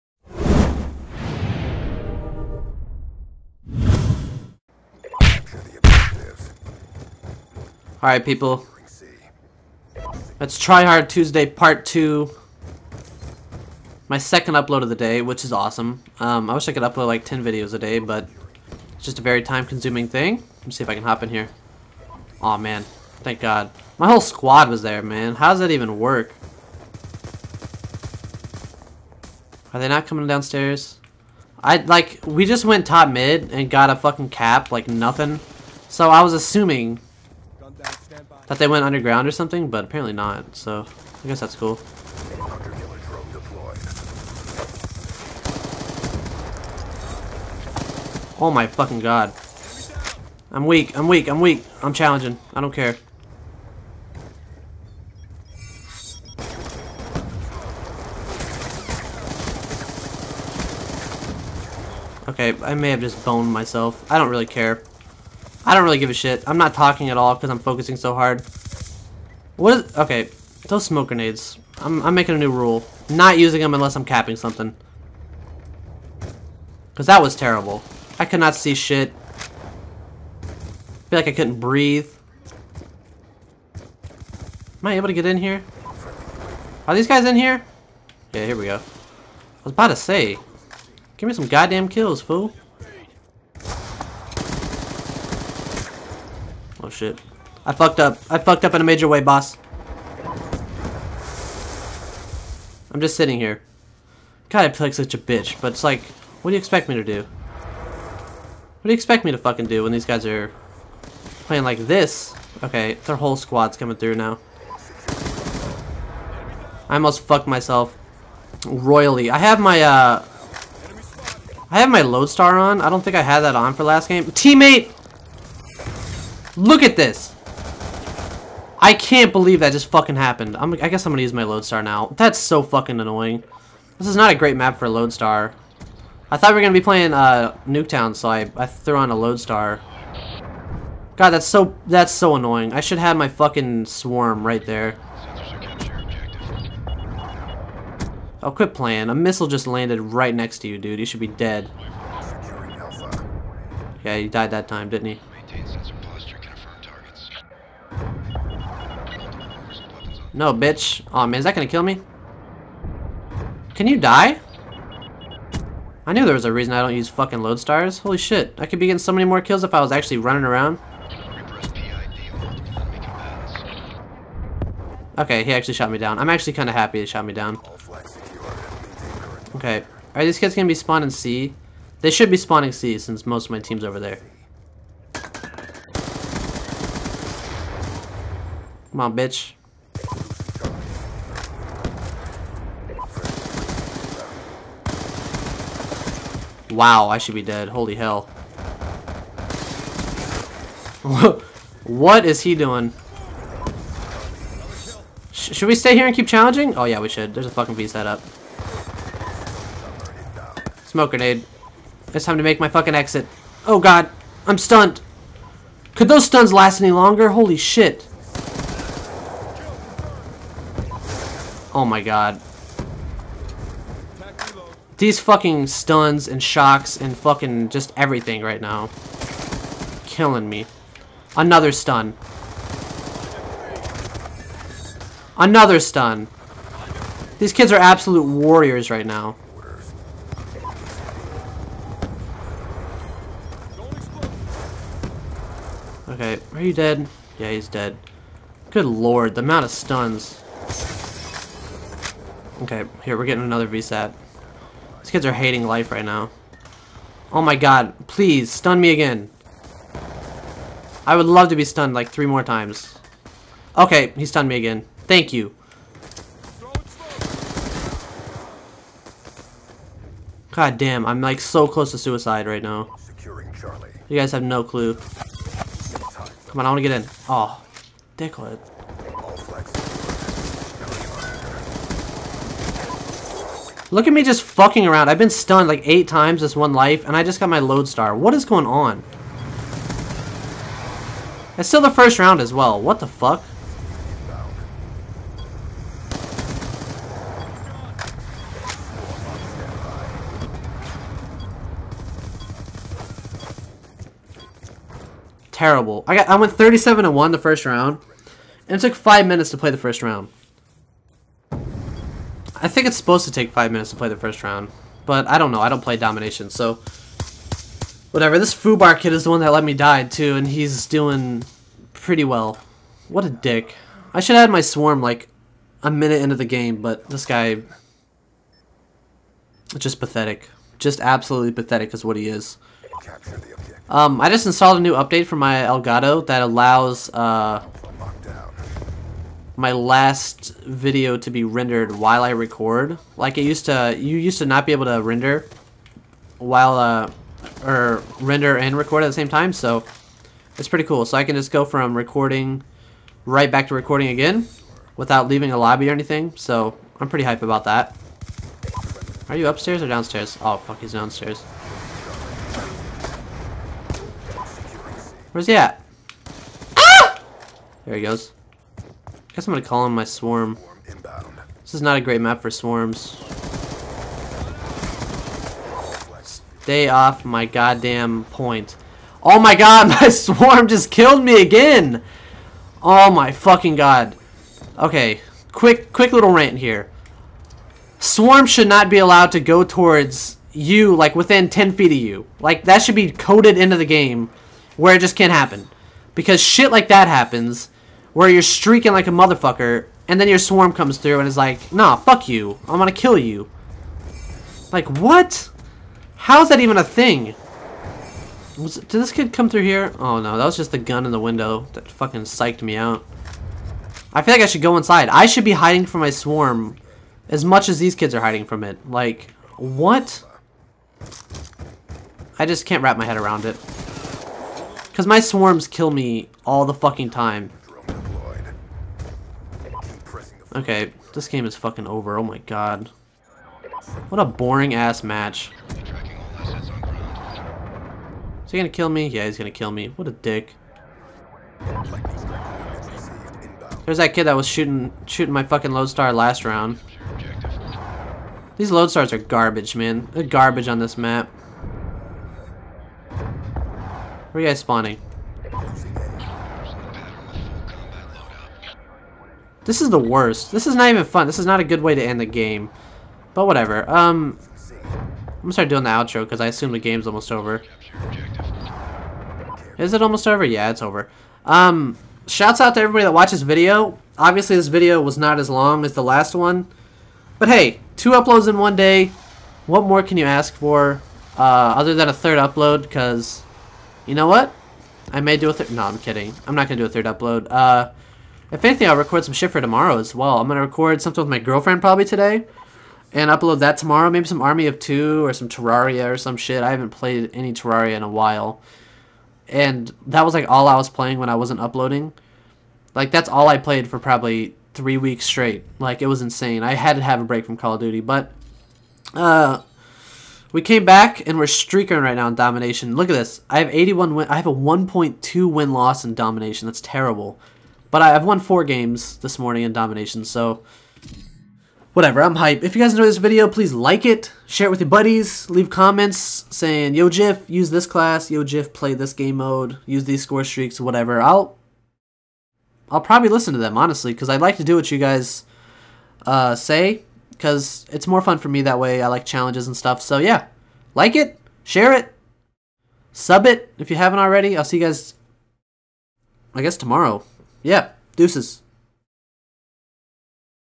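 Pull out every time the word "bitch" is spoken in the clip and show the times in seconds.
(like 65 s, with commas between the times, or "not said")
105 s, 160 s, 189 s.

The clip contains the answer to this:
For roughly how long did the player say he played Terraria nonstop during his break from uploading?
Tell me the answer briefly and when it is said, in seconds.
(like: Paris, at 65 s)
3 weeks, at 504 s.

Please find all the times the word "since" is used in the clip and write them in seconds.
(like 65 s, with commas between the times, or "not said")
182 s.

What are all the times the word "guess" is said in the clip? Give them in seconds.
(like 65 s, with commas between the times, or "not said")
41 s, 130 s, 369 s, 546 s.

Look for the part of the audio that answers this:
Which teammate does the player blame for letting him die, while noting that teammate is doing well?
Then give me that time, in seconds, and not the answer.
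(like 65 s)
318 s.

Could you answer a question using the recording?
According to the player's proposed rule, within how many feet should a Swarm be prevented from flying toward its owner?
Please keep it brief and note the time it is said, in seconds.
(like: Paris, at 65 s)
10 feet, at 391 s.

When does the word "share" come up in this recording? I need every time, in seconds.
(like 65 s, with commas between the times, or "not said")
524 s, 541 s.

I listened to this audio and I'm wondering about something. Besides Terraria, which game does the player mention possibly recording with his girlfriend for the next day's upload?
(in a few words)
Army of Two.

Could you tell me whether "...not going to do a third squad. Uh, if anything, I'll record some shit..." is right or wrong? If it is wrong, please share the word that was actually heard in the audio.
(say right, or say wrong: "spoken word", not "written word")
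wrong: "upload", not "squad".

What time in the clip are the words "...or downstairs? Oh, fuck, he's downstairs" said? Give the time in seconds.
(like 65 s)
359 s.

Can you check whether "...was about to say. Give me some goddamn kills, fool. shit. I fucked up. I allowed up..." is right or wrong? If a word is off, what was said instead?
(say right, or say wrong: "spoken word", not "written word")
wrong: "fucked", not "allowed".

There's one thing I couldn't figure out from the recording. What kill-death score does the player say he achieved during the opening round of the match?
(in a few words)
37 to 1.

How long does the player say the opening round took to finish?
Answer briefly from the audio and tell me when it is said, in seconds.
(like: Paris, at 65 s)
5 minutes, at 308 s.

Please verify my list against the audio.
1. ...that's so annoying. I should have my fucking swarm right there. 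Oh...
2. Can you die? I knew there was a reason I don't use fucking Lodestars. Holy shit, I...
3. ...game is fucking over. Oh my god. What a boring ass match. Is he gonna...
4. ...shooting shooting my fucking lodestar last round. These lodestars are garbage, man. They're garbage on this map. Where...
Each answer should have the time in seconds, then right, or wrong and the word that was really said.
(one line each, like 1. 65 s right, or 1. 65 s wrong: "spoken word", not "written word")
1. 141 s right
2. 163 s right
3. 431 s right
4. 444 s right.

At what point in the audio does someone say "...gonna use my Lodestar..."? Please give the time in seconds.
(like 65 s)
131 s.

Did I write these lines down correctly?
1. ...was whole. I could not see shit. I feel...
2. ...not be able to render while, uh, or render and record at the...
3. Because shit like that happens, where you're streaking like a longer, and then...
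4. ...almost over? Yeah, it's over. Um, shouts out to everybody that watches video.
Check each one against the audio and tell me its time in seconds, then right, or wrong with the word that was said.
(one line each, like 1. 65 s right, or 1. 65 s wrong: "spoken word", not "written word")
1. 77 s wrong: "terrible", not "whole"
2. 344 s right
3. 396 s wrong: "motherfucker", not "longer"
4. 470 s right.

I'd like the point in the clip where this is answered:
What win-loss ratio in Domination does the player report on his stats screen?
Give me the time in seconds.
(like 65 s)
514 s.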